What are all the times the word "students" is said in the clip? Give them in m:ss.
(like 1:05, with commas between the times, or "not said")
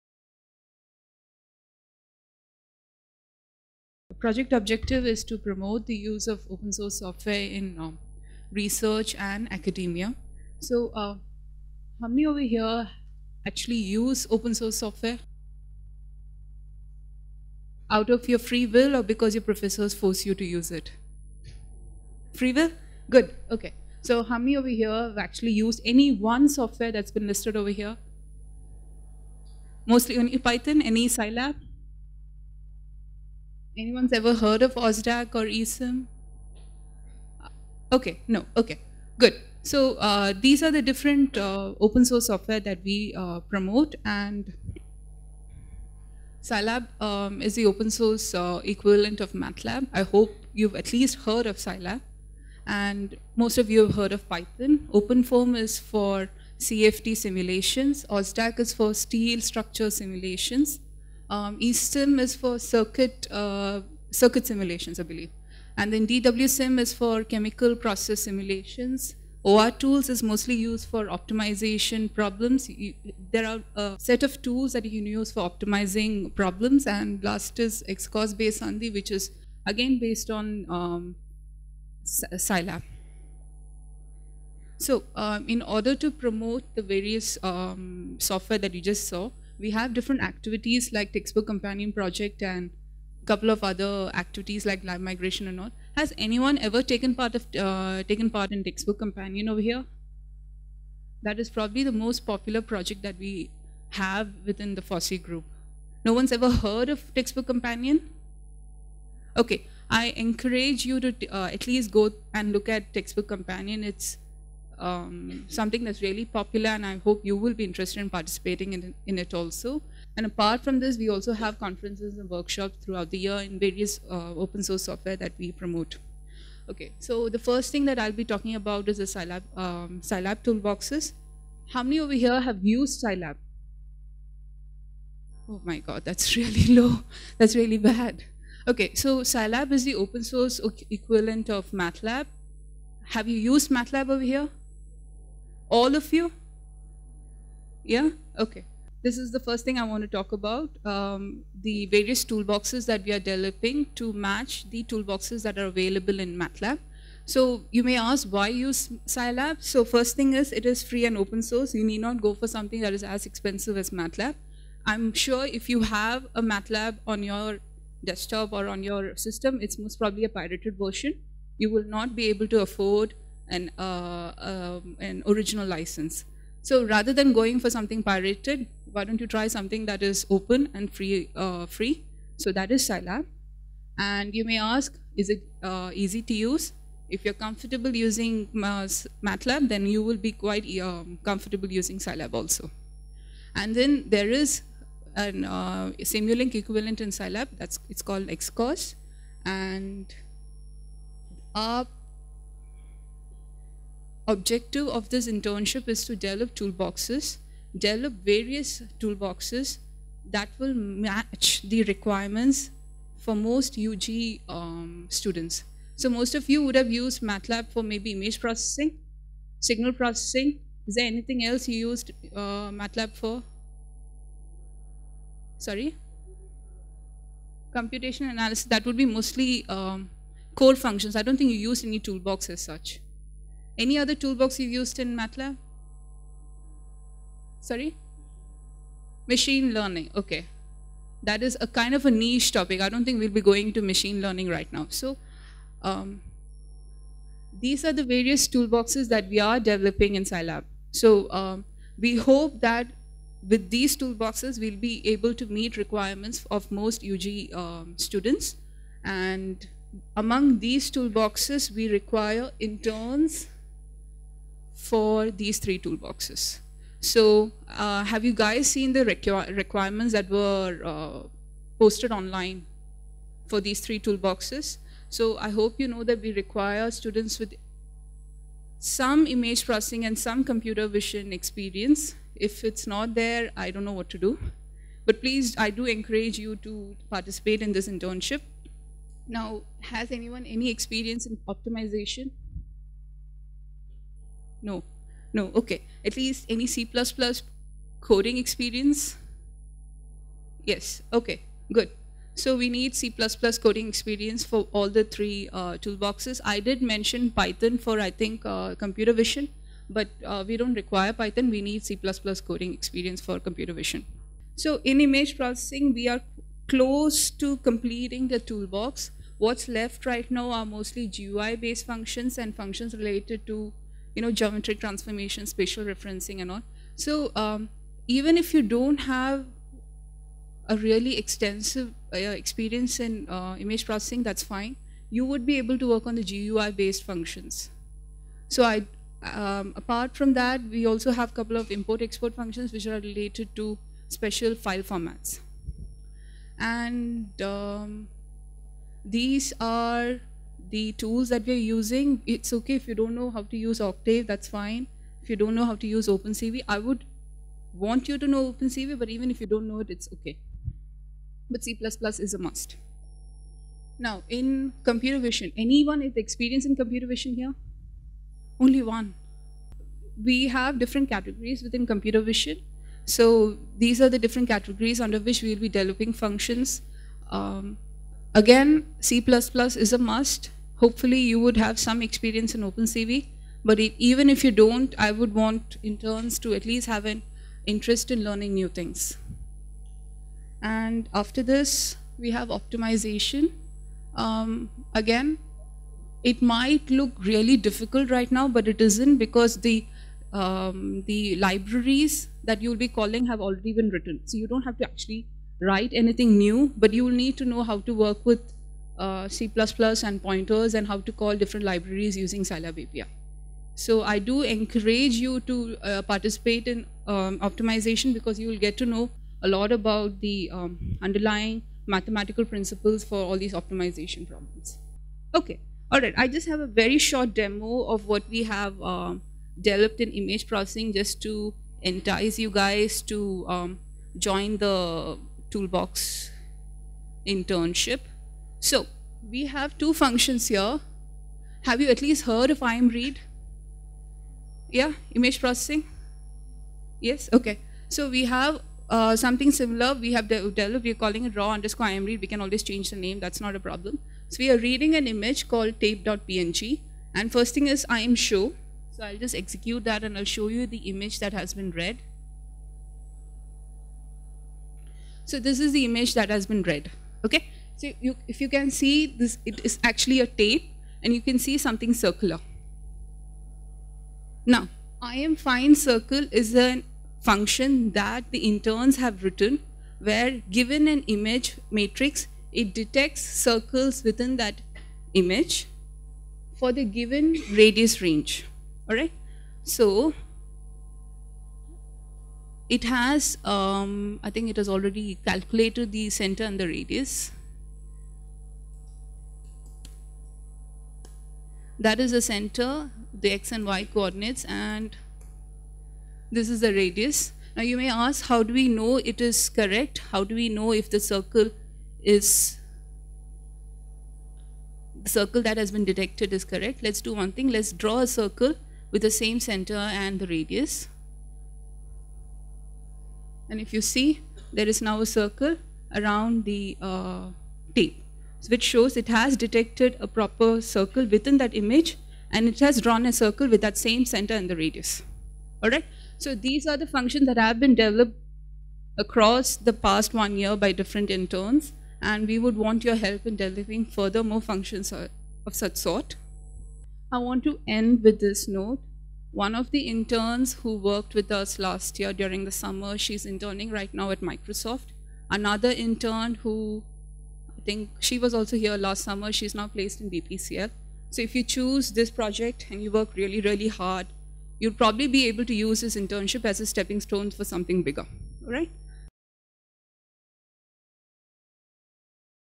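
3:35, 4:17, 4:36.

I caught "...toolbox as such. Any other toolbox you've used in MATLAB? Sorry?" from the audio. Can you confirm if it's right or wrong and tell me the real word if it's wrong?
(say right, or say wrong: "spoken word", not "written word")
right.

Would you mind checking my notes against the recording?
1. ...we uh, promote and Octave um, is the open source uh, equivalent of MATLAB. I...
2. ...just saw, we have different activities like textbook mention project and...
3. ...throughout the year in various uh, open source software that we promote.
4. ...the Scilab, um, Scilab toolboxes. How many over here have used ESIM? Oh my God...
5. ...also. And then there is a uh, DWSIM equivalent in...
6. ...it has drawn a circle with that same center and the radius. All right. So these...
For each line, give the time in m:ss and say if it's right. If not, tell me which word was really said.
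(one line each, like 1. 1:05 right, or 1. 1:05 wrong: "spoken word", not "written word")
1. 0:42 wrong: "Scilab", not "Octave"
2. 1:28 wrong: "companion", not "mention"
3. 2:02 right
4. 2:08 wrong: "Scilab", not "ESIM"
5. 3:12 wrong: "Simulink", not "DWSIM"
6. 8:52 right.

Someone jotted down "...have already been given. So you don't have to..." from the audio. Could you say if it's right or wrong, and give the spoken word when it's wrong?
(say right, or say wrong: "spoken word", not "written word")
wrong: "written", not "given".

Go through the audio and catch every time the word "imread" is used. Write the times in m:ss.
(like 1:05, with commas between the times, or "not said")
7:22, 7:31.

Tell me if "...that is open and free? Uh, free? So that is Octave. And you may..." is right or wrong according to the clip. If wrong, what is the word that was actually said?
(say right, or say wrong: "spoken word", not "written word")
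wrong: "Scilab", not "Octave".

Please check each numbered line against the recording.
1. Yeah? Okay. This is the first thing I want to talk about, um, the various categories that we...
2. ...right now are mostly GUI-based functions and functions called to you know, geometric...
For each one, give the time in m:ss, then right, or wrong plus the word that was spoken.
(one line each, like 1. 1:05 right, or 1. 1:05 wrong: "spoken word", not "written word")
1. 2:27 wrong: "toolboxes", not "categories"
2. 5:20 wrong: "related", not "called".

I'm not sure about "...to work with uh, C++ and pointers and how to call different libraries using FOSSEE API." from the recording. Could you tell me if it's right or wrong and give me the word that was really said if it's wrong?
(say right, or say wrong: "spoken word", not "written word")
wrong: "Scilab", not "FOSSEE".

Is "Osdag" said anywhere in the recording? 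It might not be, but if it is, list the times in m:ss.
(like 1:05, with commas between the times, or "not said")
0:34, 0:58.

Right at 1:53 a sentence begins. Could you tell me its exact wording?
It's um, something that's really popular and I hope you will be interested in participating in, in it also.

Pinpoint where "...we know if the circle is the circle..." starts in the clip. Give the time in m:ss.
8:30.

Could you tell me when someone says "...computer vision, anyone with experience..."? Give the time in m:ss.
6:04.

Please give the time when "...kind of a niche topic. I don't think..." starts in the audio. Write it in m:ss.
4:01.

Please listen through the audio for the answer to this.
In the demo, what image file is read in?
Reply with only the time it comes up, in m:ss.
7:35.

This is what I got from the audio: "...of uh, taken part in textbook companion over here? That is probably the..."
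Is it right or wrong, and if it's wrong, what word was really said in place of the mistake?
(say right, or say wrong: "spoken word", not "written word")
right.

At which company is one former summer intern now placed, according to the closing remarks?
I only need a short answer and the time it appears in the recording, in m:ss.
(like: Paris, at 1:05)
BPCL, at 9:20.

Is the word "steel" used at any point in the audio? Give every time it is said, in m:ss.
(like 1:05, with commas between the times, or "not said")
0:58.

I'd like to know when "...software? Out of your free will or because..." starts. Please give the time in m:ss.
0:14.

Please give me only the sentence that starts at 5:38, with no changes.
So I, um, apart from that, we also have a couple of import-export functions which are related to special file formats.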